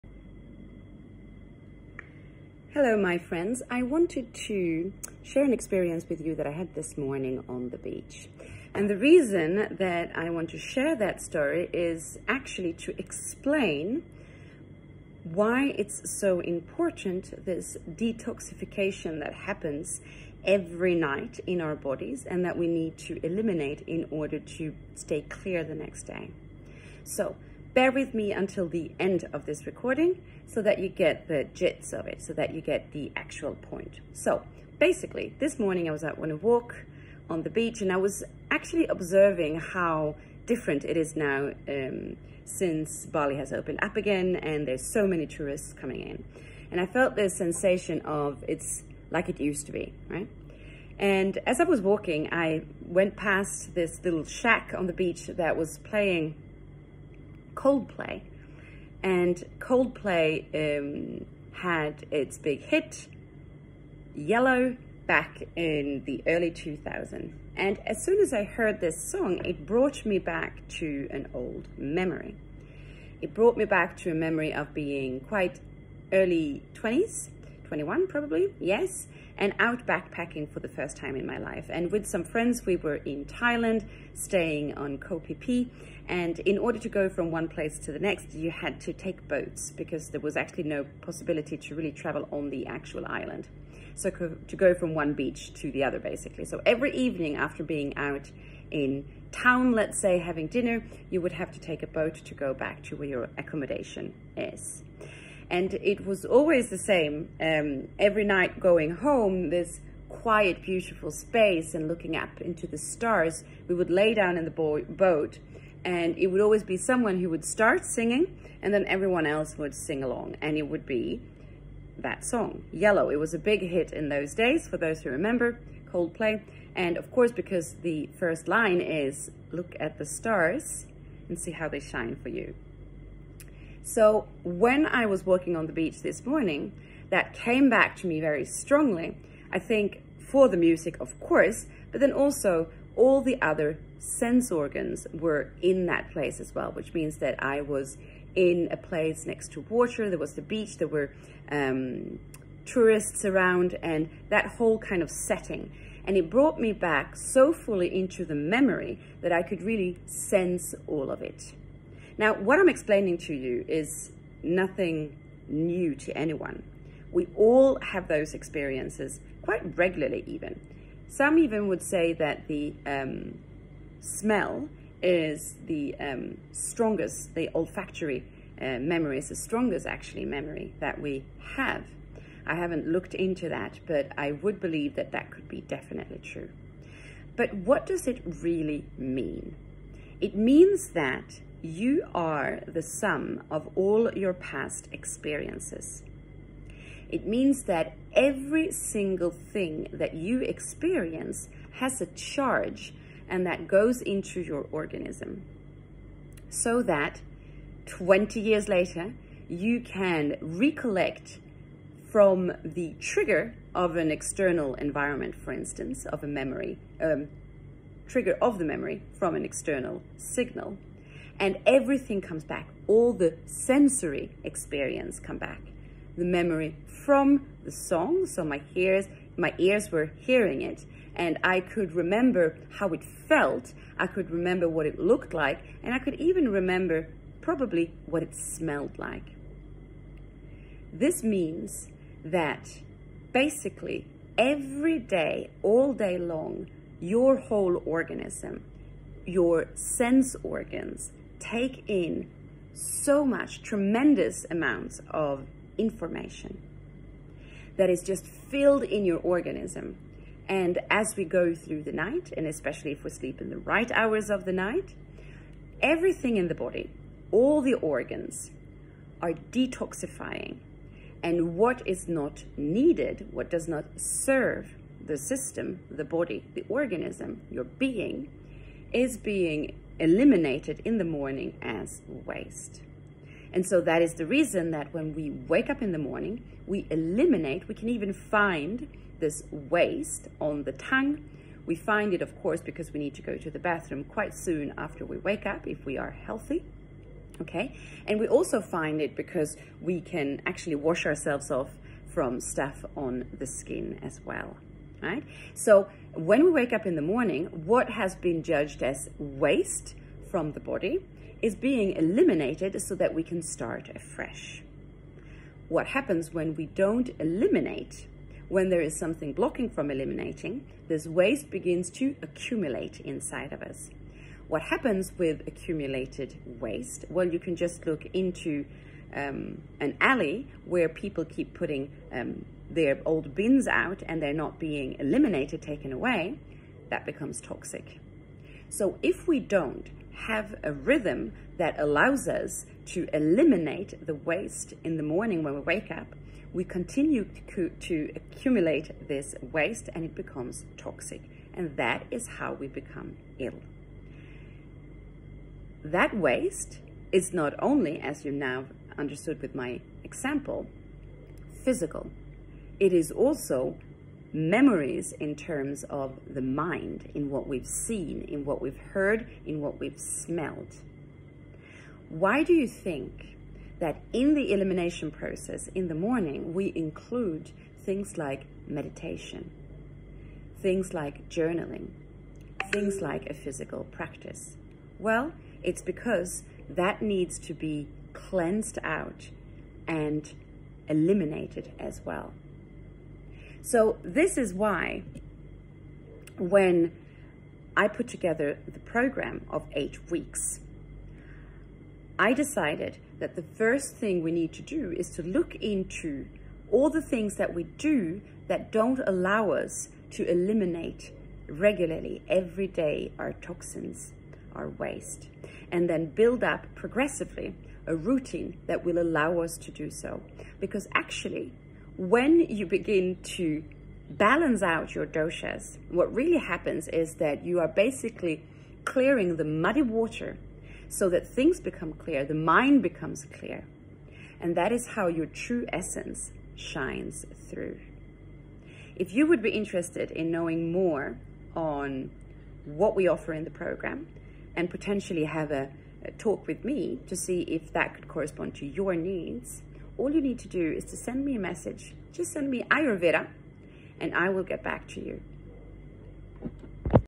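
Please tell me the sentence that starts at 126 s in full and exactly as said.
And of course, because the first line is, look at the stars and see how they shine for you.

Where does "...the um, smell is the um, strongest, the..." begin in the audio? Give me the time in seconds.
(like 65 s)
172 s.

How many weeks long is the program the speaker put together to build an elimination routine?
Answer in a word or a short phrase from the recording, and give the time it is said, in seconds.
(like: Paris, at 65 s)
8, at 399 s.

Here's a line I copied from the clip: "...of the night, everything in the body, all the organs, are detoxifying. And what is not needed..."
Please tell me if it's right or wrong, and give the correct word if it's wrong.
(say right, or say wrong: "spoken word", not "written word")
right.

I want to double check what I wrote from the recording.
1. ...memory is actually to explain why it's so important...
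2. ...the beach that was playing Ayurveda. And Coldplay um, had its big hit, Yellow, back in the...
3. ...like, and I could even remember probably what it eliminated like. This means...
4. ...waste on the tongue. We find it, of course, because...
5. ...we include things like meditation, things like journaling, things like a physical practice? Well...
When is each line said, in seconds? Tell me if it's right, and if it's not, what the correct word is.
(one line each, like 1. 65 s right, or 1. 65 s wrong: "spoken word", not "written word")
1. 11 s wrong: "story", not "memory"
2. 54 s wrong: "Coldplay", not "Ayurveda"
3. 235 s wrong: "smelled", not "eliminated"
4. 289 s right
5. 376 s right.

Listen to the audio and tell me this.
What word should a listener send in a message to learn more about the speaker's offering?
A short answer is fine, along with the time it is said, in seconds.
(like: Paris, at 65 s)
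Ayurveda, at 452 s.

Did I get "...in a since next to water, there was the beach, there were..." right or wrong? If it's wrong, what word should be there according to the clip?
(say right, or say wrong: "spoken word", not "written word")
wrong: "place", not "since".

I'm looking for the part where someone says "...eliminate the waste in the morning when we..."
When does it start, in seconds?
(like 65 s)
343 s.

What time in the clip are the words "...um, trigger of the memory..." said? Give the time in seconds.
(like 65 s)
216 s.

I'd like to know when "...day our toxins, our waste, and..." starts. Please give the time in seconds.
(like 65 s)
412 s.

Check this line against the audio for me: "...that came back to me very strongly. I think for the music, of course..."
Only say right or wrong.
right.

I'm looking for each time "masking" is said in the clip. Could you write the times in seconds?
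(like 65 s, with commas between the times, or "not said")
not said.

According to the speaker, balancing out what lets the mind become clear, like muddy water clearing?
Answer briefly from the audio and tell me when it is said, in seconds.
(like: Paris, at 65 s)
doshas, at 425 s.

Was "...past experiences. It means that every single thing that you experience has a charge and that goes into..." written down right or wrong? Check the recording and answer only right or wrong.
right.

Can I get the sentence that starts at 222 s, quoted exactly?
All the sensory experience come back.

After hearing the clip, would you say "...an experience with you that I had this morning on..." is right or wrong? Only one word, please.
right.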